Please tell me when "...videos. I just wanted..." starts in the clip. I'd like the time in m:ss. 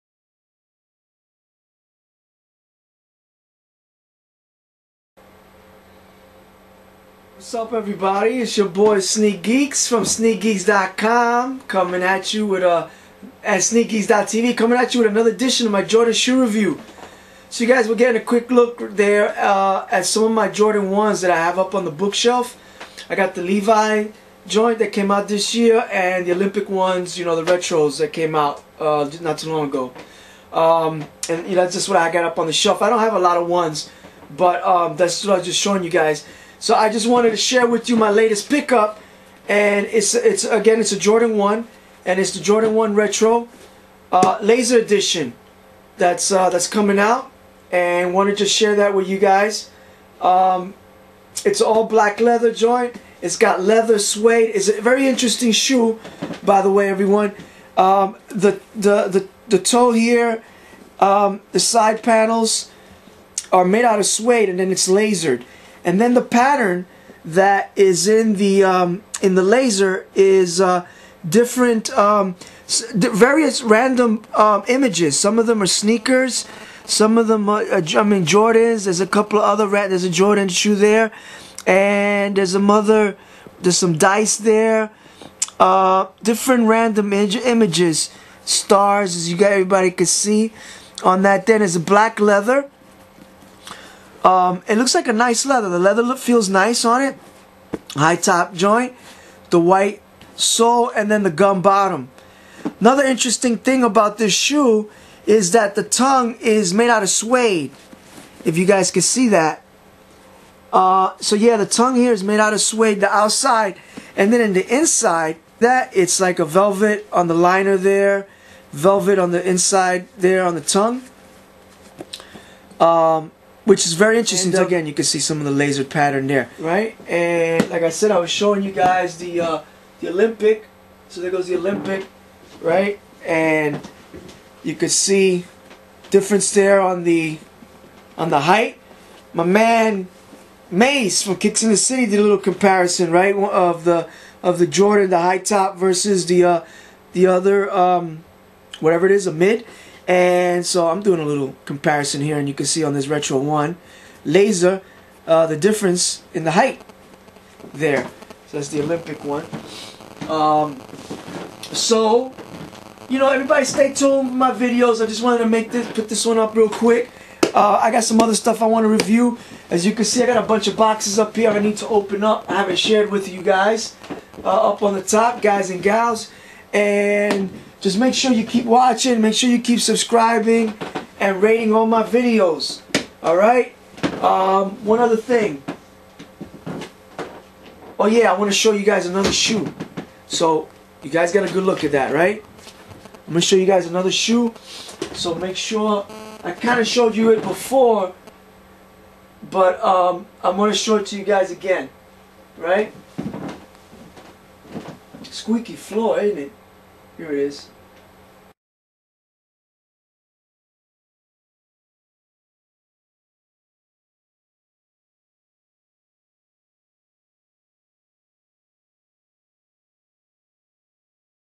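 2:44.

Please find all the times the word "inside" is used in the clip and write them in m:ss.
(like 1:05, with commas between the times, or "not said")
1:54, 1:59.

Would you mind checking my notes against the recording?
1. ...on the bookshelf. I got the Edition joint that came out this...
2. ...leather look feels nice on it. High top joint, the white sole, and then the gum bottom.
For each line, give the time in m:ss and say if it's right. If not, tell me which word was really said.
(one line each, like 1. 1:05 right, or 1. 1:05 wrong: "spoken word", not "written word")
1. 0:21 wrong: "Levi", not "Edition"
2. 1:35 right.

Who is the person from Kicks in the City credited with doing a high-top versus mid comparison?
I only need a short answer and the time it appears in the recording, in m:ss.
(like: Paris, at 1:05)
Mace, at 2:20.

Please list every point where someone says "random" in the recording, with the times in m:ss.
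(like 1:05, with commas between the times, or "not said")
1:13, 1:26.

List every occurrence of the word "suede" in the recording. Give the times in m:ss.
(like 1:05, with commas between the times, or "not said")
0:53, 1:04, 1:47, 1:52.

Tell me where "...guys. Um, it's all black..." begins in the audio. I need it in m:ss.
0:49.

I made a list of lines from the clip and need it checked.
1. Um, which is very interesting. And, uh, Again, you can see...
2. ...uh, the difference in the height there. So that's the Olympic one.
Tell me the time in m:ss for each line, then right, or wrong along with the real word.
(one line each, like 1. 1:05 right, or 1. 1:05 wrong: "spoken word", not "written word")
1. 2:02 right
2. 2:35 right.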